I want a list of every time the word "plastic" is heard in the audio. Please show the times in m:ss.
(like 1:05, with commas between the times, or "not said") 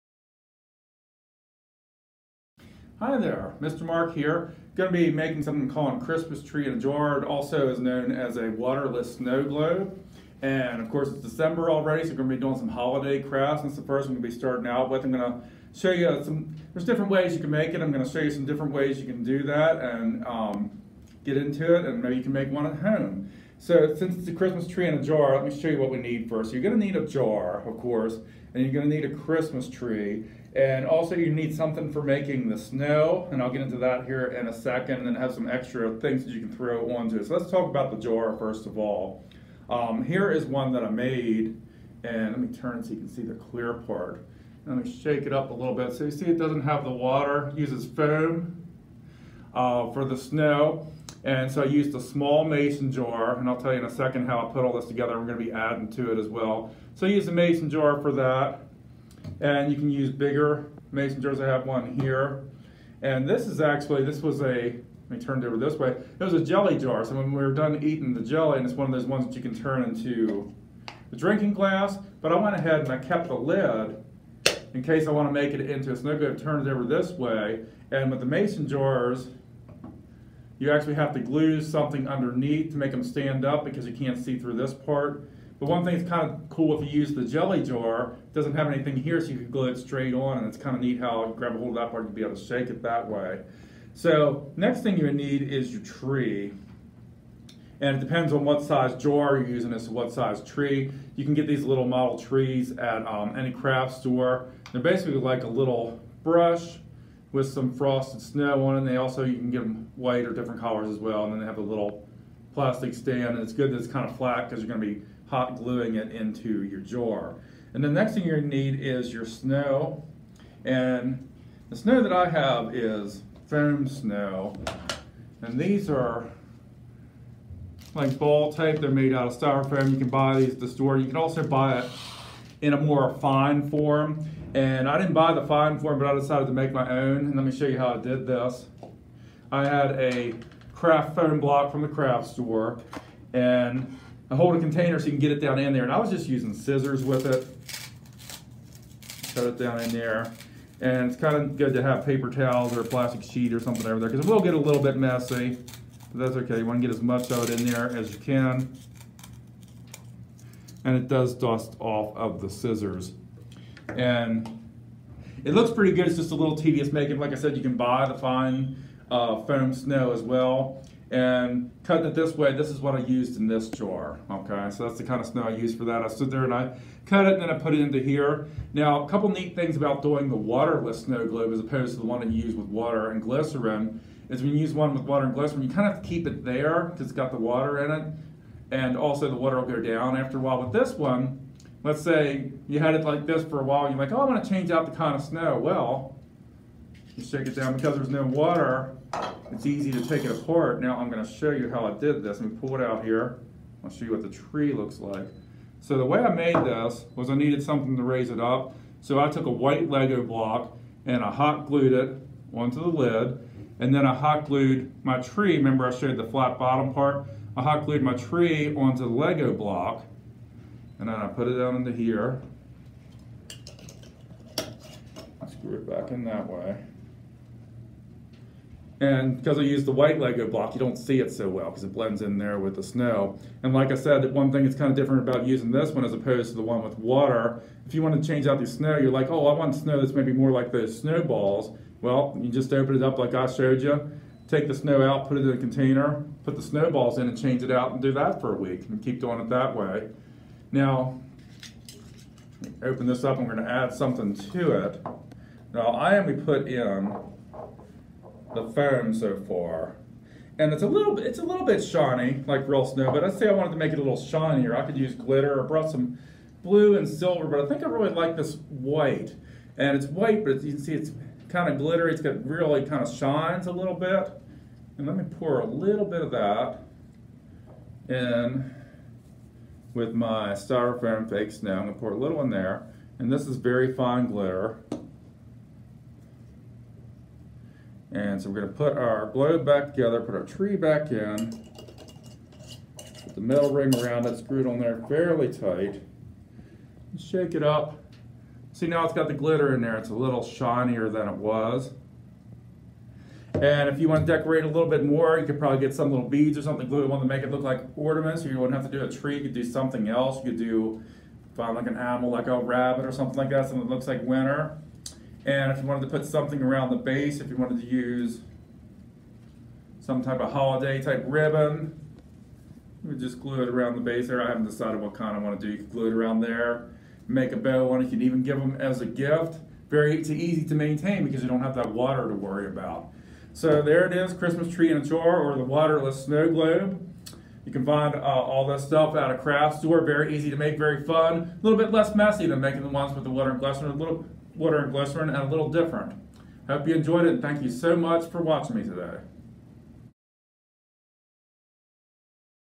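1:52, 2:32.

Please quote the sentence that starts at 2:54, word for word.
So that's the kind of snow I used for that.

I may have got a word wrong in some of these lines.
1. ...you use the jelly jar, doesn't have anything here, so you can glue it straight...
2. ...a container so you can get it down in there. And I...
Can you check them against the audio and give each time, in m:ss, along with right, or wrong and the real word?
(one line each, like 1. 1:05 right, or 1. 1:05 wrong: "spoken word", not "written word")
1. 1:26 right
2. 2:24 right.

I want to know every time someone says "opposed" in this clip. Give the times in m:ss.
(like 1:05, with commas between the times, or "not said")
3:01, 3:56.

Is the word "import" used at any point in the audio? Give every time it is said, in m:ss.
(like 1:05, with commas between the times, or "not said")
not said.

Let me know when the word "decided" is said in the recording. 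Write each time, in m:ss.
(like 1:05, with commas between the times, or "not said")
2:16, 5:24.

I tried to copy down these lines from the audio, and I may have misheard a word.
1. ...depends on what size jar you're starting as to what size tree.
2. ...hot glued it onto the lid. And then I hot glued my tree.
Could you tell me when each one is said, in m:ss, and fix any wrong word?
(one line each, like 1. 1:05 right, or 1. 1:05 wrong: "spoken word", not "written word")
1. 1:37 wrong: "using", not "starting"
2. 3:31 right.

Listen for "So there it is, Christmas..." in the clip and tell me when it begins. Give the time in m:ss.
5:33.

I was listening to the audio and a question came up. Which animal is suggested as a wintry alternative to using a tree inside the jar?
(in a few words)
rabbit.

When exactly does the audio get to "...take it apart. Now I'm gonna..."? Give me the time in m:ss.
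3:20.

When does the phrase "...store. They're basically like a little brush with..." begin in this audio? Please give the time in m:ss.
1:43.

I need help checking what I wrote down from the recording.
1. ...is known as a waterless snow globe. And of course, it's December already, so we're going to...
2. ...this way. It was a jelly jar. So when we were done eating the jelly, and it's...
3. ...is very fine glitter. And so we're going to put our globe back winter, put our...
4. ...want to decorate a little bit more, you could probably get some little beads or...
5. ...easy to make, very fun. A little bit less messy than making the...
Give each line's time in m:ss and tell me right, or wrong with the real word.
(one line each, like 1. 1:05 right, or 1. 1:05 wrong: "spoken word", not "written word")
1. 0:07 right
2. 1:05 right
3. 4:43 wrong: "together", not "winter"
4. 5:04 right
5. 5:40 right.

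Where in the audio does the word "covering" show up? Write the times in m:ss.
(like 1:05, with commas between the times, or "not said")
not said.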